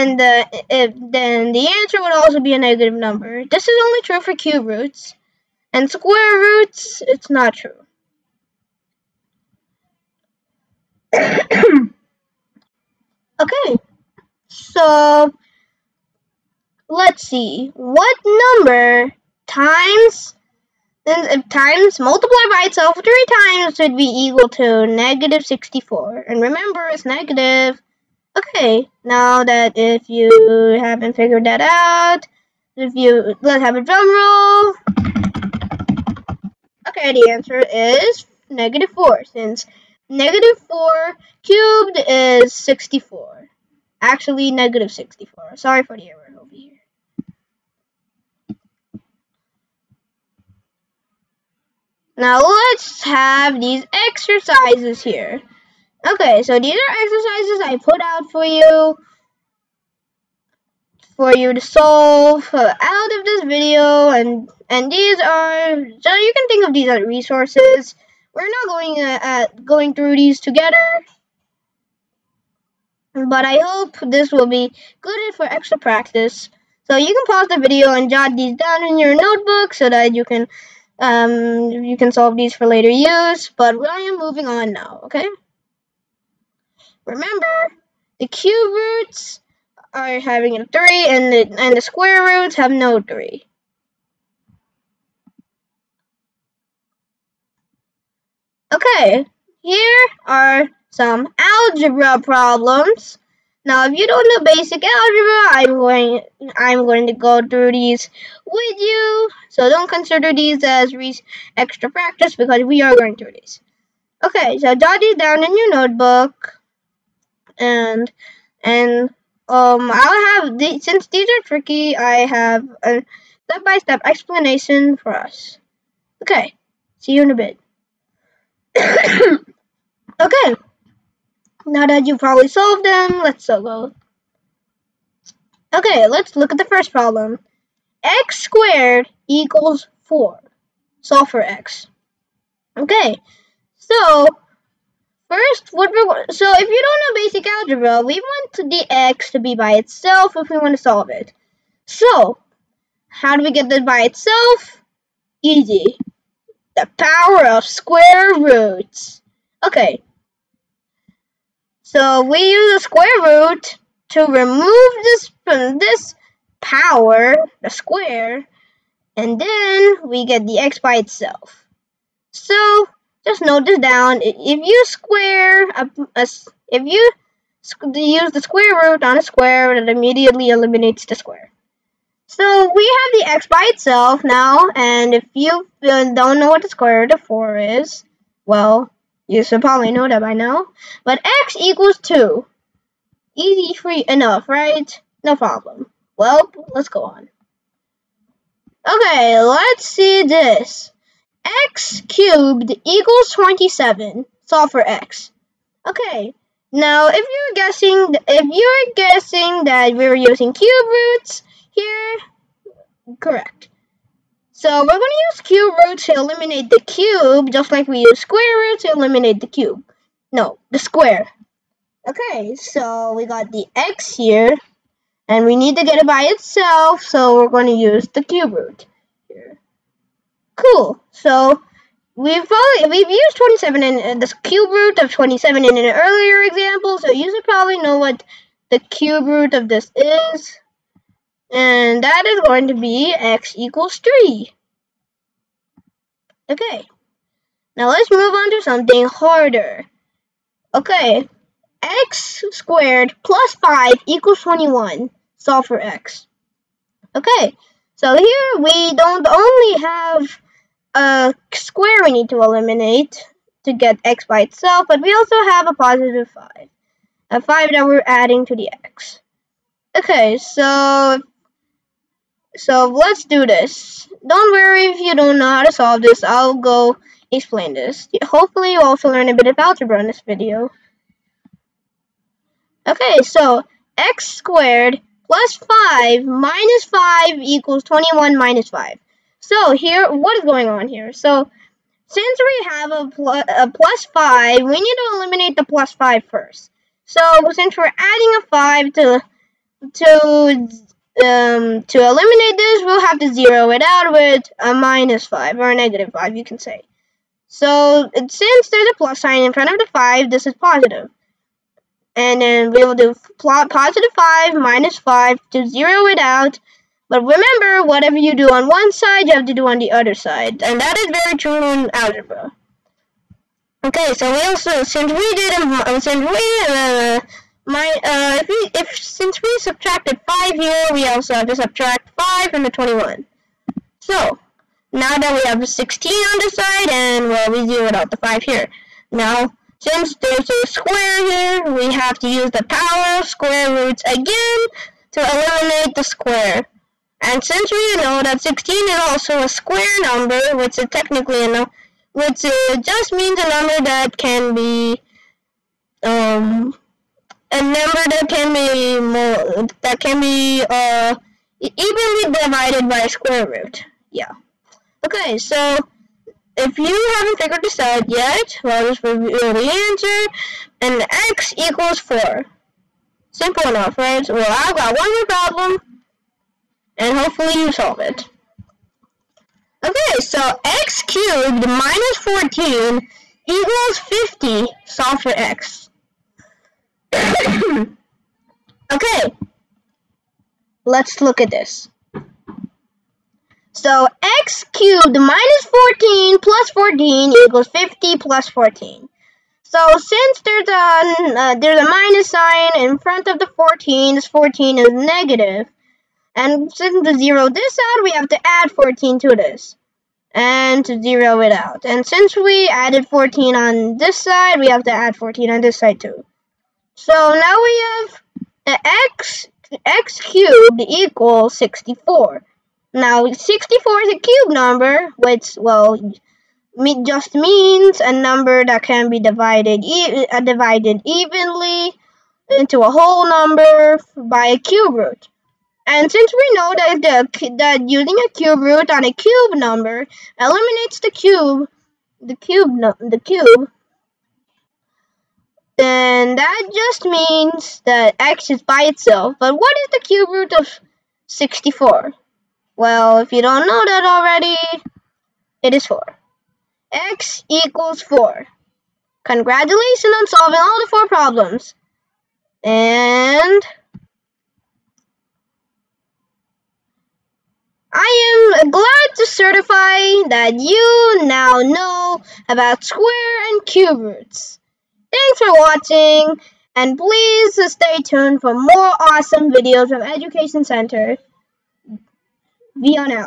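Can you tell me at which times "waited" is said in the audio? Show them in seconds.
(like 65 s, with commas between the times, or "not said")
not said.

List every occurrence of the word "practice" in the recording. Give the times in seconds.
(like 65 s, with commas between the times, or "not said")
75 s, 111 s.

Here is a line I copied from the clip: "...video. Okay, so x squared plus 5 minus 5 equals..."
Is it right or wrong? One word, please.
right.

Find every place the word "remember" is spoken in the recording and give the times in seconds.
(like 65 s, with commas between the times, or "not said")
26 s, 87 s, 317 s.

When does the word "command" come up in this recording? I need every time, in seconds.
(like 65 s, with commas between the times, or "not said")
not said.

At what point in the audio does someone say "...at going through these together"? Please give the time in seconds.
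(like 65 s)
69 s.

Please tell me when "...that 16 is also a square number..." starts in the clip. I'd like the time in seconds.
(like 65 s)
348 s.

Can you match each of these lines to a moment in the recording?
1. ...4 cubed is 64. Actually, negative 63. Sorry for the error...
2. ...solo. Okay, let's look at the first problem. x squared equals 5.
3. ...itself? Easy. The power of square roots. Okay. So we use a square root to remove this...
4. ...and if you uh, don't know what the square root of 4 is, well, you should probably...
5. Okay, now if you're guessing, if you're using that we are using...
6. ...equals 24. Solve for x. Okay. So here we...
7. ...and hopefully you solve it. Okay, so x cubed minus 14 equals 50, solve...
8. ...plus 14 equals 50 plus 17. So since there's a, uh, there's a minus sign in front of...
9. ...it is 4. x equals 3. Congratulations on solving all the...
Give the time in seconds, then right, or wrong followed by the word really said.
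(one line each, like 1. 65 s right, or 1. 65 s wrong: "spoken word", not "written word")
1. 40 s wrong: "64", not "63"
2. 133 s wrong: "4", not "5"
3. 154 s right
4. 184 s right
5. 205 s wrong: "guessing", not "using"
6. 254 s wrong: "21", not "24"
7. 376 s right
8. 396 s wrong: "14", not "17"
9. 455 s wrong: "4", not "3".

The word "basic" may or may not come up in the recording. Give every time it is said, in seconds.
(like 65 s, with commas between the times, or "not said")
104 s, 147 s.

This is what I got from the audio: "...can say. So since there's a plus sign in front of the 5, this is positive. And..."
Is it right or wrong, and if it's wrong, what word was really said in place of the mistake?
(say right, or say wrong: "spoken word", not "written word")
right.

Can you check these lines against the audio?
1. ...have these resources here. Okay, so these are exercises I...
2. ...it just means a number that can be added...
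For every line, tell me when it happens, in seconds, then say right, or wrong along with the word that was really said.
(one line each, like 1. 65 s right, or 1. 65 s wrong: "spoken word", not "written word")
1. 53 s wrong: "exercises", not "resources"
2. 426 s wrong: "divided", not "added".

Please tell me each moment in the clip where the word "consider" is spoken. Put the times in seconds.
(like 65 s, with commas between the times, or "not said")
109 s.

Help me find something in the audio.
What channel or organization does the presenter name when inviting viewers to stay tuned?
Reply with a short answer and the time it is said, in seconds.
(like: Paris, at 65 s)
Education Center, at 480 s.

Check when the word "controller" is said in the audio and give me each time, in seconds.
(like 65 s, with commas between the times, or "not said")
not said.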